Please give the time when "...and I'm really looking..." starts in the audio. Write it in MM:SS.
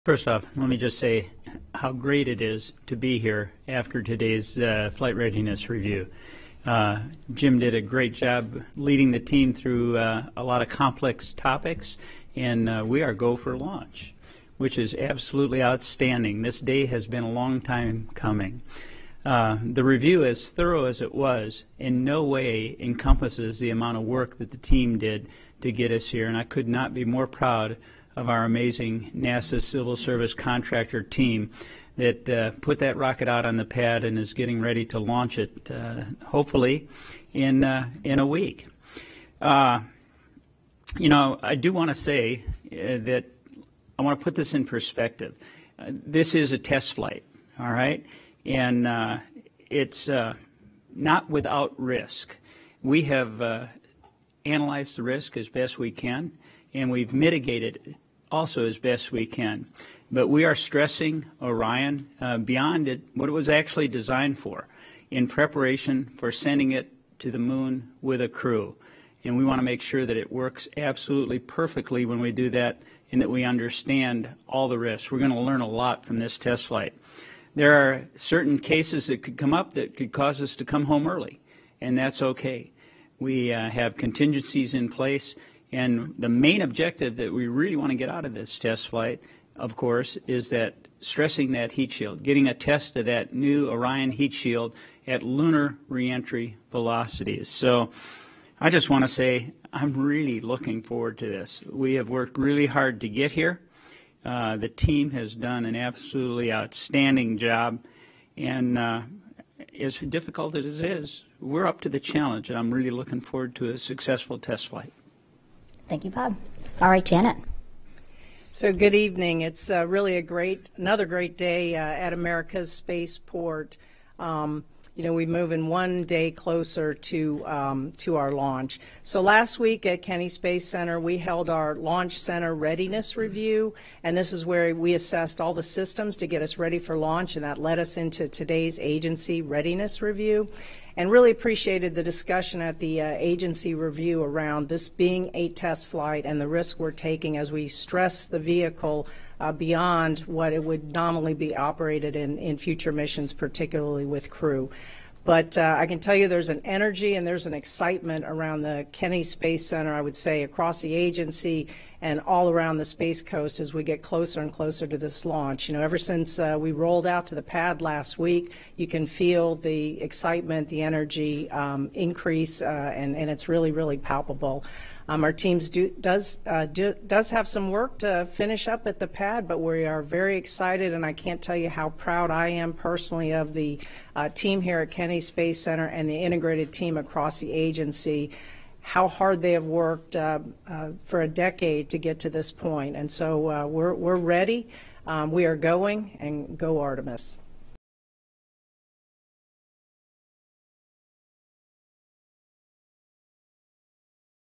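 01:52.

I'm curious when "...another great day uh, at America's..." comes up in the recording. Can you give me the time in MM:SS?
02:00.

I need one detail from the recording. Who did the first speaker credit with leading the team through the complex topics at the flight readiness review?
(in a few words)
Jim.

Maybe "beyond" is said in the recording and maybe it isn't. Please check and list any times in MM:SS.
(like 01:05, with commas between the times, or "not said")
01:02, 02:29.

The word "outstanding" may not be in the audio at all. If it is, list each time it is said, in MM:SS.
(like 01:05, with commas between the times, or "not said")
00:15, 01:46.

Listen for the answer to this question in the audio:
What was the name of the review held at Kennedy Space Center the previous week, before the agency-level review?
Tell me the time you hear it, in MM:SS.
02:11.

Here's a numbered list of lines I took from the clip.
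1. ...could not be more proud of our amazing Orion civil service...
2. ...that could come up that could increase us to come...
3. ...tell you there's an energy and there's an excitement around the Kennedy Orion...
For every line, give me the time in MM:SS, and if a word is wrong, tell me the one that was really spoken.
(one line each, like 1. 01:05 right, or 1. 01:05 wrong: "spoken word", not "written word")
1. 00:26 wrong: "NASA", not "Orion"
2. 01:19 wrong: "cause", not "increase"
3. 02:35 wrong: "Space", not "Orion".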